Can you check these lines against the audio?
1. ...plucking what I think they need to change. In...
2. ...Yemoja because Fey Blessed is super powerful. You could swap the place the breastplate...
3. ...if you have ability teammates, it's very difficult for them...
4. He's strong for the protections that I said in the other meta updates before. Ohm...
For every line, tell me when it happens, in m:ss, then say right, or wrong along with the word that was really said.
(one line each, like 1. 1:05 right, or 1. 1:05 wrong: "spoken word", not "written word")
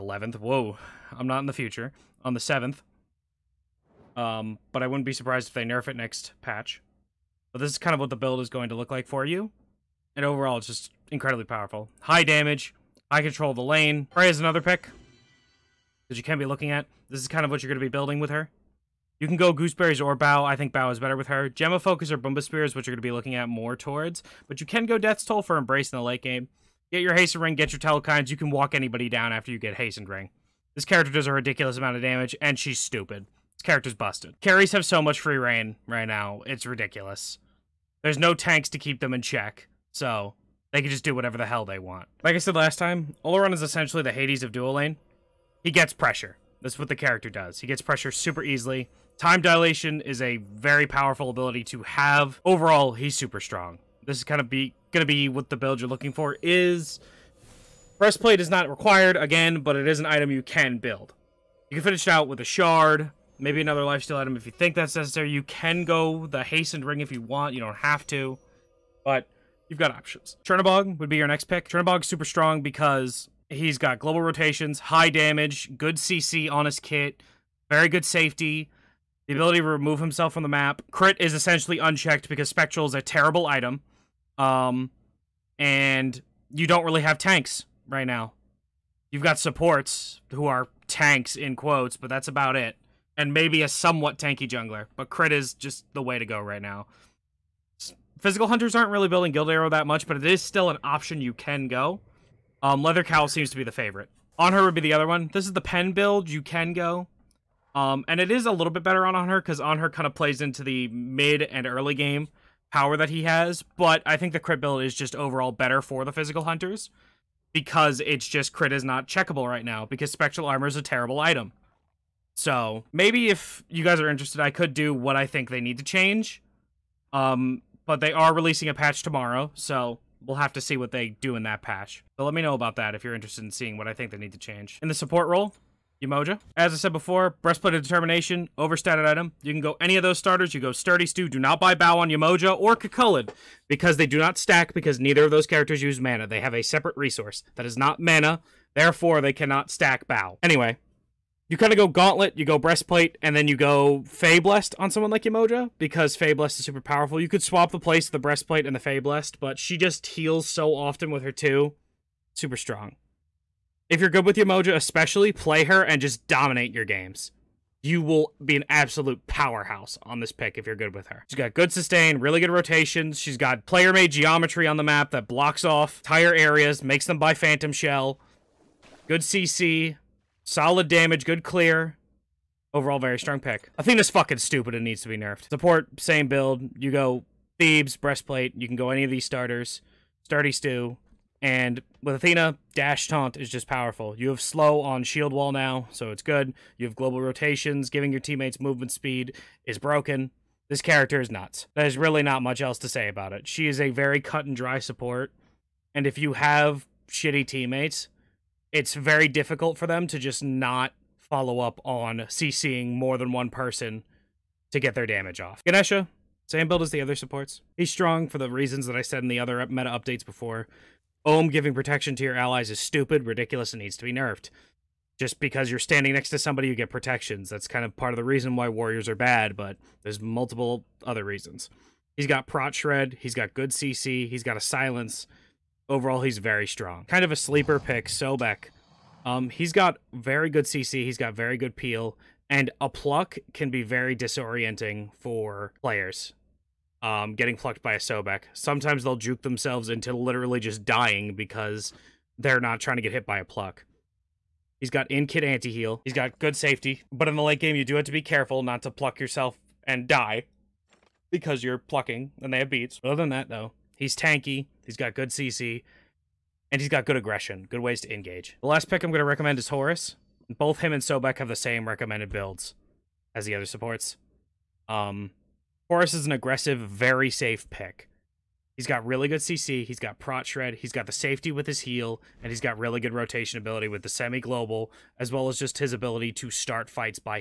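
1. 2:13 wrong: "seeing", not "plucking"
2. 2:35 right
3. 3:26 wrong: "shitty", not "ability"
4. 3:37 wrong: "reasons", not "protections".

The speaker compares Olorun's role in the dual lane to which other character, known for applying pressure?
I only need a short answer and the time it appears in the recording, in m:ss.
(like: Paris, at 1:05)
Hades, at 0:44.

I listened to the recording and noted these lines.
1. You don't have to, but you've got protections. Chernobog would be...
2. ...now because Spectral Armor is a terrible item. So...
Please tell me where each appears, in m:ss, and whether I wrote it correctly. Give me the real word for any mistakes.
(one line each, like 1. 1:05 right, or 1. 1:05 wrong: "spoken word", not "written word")
1. 1:07 wrong: "options", not "protections"
2. 1:59 right.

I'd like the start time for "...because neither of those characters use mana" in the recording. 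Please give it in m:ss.
2:24.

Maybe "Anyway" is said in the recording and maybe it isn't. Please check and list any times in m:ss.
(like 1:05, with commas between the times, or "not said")
2:30.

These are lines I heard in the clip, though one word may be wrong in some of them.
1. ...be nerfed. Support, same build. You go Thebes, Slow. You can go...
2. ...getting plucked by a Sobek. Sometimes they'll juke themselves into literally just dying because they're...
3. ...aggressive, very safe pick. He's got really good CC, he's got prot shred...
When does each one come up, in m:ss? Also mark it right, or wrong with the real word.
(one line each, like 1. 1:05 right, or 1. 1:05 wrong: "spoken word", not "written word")
1. 3:05 wrong: "Breastplate", not "Slow"
2. 4:07 right
3. 4:36 right.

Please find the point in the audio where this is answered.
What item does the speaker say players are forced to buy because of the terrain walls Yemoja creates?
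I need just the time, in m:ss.
2:57.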